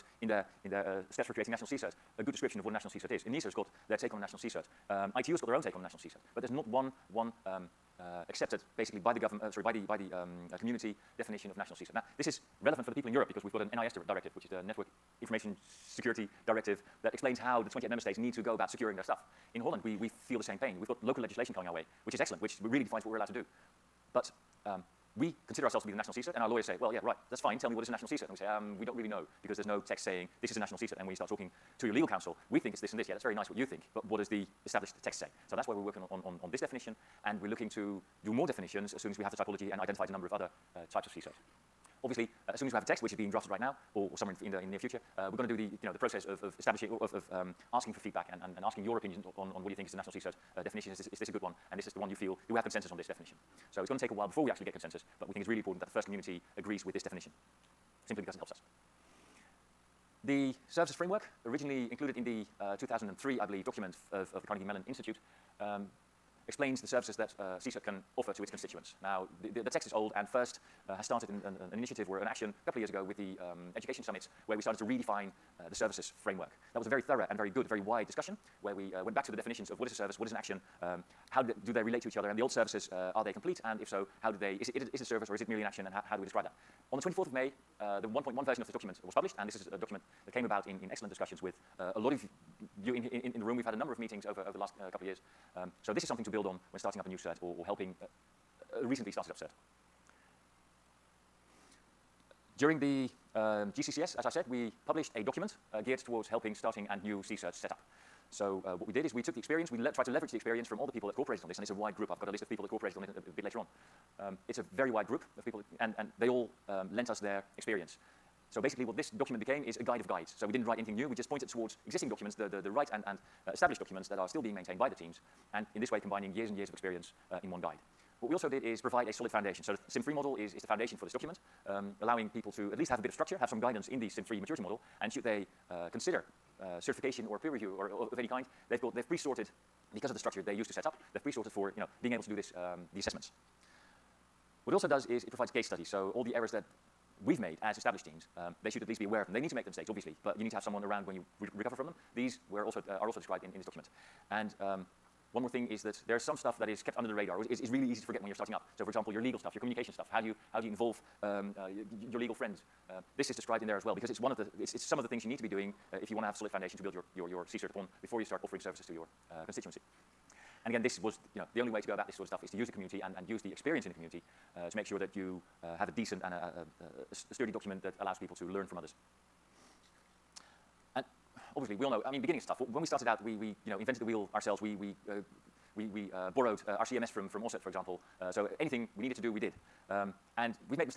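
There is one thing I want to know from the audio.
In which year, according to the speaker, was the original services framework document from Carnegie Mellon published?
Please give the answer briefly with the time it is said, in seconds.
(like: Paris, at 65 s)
2003, at 62 s.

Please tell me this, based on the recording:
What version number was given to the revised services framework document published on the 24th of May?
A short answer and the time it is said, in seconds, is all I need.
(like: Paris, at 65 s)
1.1, at 88 s.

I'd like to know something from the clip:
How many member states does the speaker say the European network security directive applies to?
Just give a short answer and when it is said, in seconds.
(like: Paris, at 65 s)
28, at 17 s.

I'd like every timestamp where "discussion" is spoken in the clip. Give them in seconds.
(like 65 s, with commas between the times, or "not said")
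78 s, 91 s.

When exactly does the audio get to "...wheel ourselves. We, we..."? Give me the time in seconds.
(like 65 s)
184 s.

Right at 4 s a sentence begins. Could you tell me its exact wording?
Um, ITU has got their own take on a national CSIRT.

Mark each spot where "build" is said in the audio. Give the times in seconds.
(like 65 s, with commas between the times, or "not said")
96 s, 166 s.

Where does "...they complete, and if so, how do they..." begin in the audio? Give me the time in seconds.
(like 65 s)
83 s.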